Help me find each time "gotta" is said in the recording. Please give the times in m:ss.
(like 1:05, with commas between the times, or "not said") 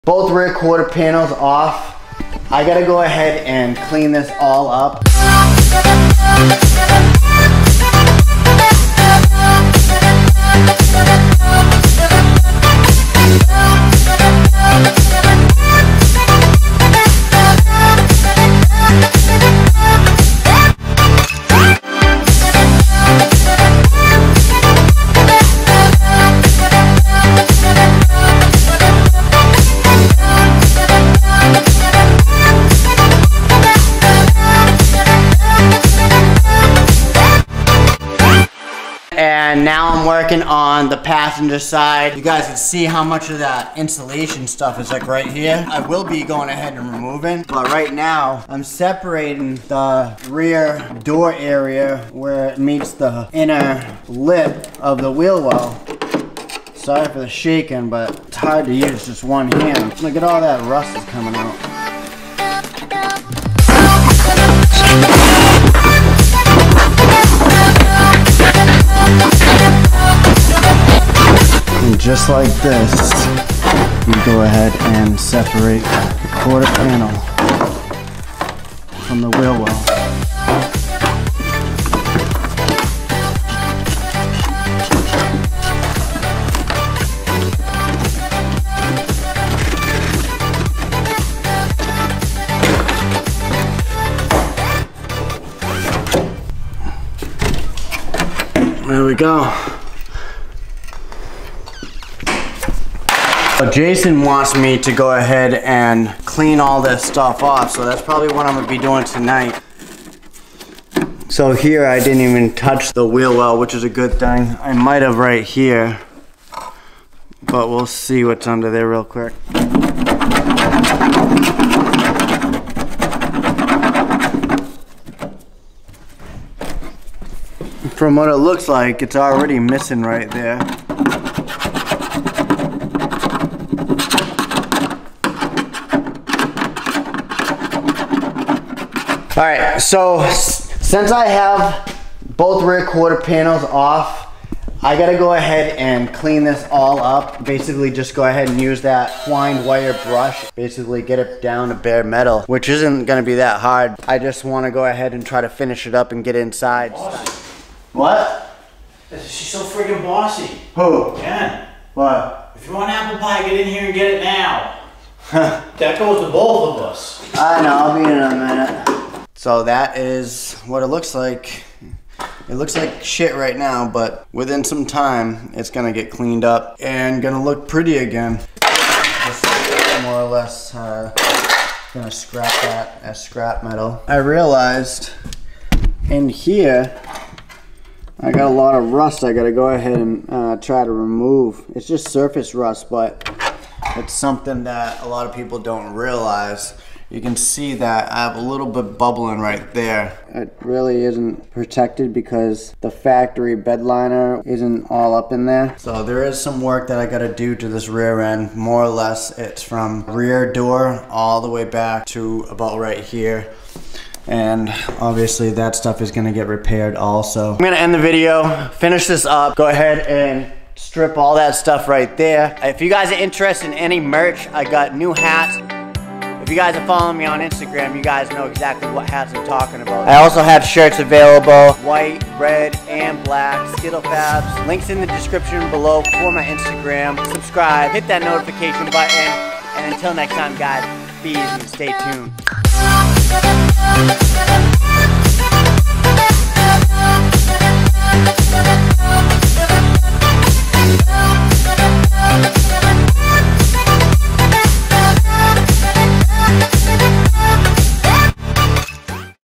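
0:02, 2:24, 3:09, 3:27.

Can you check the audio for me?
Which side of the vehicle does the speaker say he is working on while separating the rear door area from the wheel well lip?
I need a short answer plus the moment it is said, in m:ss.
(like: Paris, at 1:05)
Passenger side, at 0:40.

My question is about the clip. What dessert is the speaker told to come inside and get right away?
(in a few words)
Apple pie.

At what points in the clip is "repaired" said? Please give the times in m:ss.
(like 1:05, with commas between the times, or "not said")
3:36.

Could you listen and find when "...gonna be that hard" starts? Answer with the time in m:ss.
2:33.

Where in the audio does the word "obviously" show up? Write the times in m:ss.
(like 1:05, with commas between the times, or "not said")
3:34.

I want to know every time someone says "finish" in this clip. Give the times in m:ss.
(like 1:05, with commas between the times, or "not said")
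2:35, 3:38.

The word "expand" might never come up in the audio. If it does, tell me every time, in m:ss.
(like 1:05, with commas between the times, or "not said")
not said.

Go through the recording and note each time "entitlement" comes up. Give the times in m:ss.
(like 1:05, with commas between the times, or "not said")
not said.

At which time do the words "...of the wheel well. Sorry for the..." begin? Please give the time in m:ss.
0:54.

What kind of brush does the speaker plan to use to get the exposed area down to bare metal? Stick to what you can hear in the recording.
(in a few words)
Twined wire brush.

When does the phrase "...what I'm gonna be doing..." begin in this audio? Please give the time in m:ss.
1:48.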